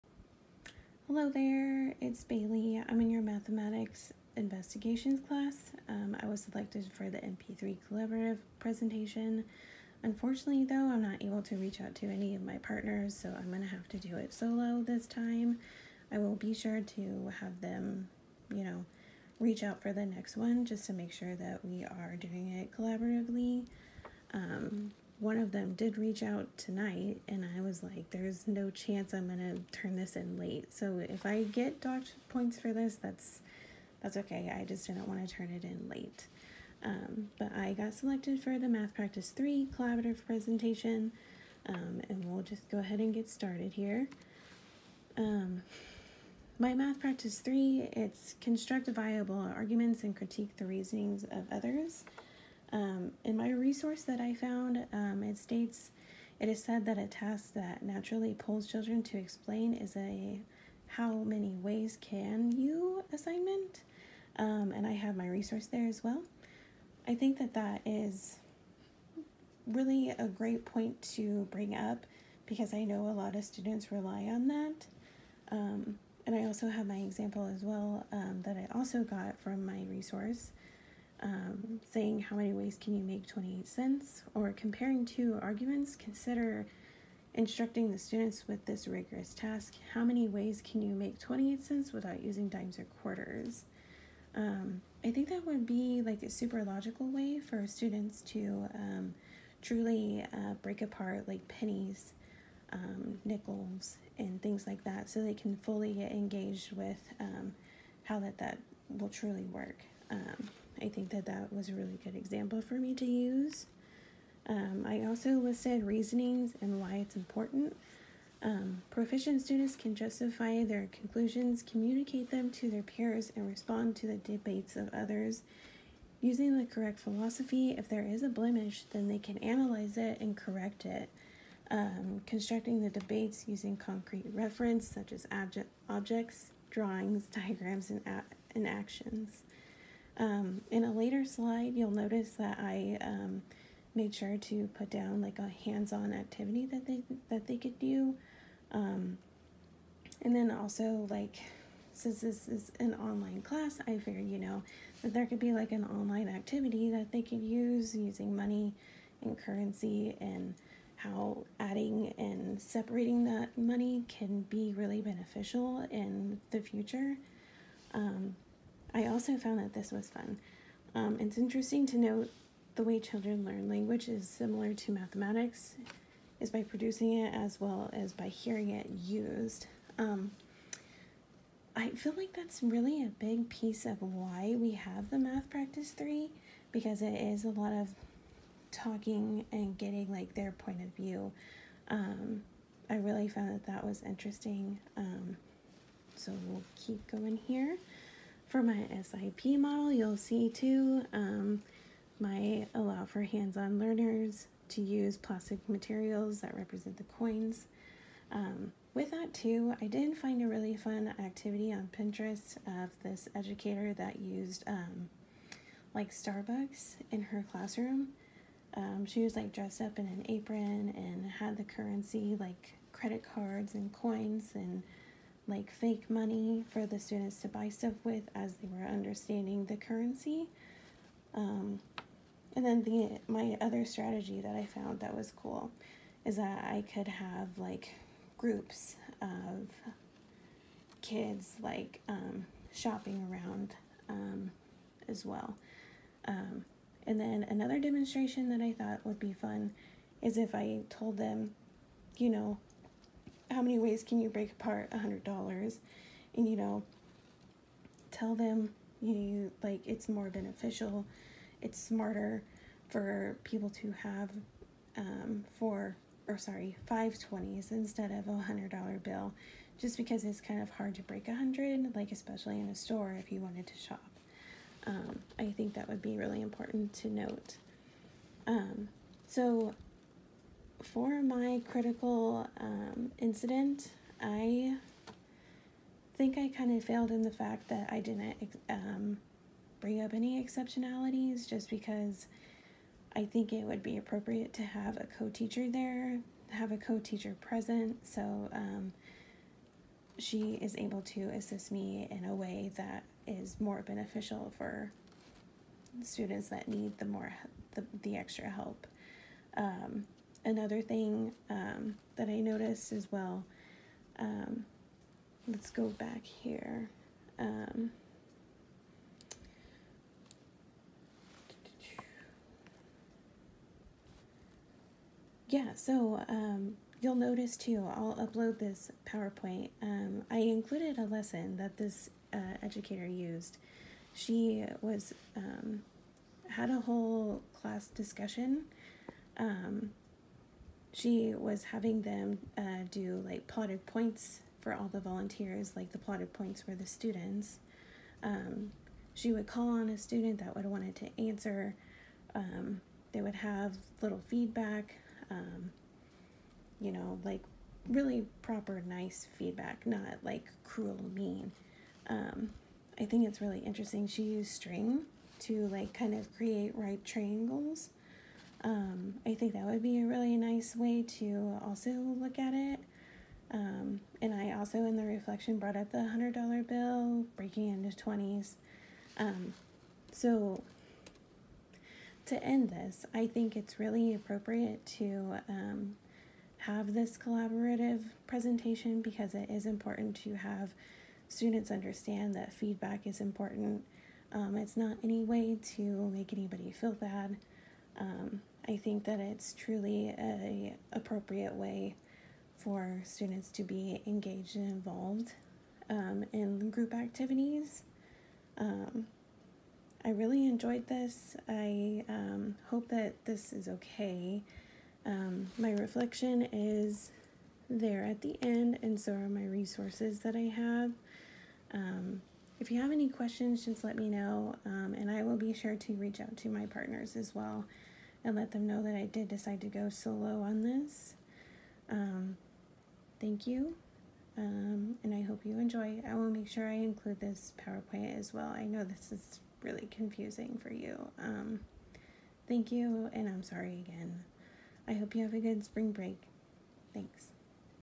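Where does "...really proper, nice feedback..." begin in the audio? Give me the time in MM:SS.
05:57.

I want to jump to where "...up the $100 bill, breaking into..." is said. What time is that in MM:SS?
06:15.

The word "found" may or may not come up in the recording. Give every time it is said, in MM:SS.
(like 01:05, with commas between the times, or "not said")
00:54, 02:49, 03:13, 03:54.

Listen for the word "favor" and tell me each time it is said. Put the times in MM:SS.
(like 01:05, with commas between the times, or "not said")
not said.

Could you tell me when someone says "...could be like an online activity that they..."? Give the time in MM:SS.
02:35.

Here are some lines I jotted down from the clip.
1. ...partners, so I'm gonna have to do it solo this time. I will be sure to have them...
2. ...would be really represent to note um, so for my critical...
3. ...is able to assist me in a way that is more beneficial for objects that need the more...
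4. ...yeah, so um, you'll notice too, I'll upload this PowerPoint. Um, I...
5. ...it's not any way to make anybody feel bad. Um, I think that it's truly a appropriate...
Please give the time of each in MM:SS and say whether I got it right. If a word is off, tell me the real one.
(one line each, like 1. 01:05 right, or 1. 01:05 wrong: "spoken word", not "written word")
1. 00:12 right
2. 04:35 wrong: "important", not "represent"
3. 05:00 wrong: "students", not "objects"
4. 05:25 right
5. 06:34 right.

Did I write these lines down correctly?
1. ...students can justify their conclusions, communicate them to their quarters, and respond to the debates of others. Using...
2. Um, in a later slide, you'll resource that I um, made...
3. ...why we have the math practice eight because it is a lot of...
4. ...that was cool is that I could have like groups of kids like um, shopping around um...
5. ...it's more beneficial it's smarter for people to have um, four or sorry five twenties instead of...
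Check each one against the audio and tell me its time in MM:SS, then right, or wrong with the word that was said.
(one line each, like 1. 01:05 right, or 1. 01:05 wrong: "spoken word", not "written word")
1. 01:59 wrong: "peers", not "quarters"
2. 02:20 wrong: "notice", not "resource"
3. 03:04 wrong: "three", not "eight"
4. 03:54 right
5. 04:19 right.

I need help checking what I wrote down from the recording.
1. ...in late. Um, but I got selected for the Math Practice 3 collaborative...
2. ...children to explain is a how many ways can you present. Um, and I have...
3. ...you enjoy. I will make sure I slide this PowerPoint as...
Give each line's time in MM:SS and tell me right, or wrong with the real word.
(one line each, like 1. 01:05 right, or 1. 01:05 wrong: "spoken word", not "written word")
1. 00:35 right
2. 00:58 wrong: "assignment", not "present"
3. 07:15 wrong: "include", not "slide".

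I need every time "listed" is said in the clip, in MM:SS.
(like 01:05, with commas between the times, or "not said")
01:55.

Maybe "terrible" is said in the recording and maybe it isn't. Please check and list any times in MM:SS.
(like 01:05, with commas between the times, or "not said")
not said.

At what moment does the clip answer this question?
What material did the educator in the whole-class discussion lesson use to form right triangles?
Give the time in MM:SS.
06:04.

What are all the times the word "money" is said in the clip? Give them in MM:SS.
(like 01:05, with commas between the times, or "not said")
02:38, 02:43, 03:46.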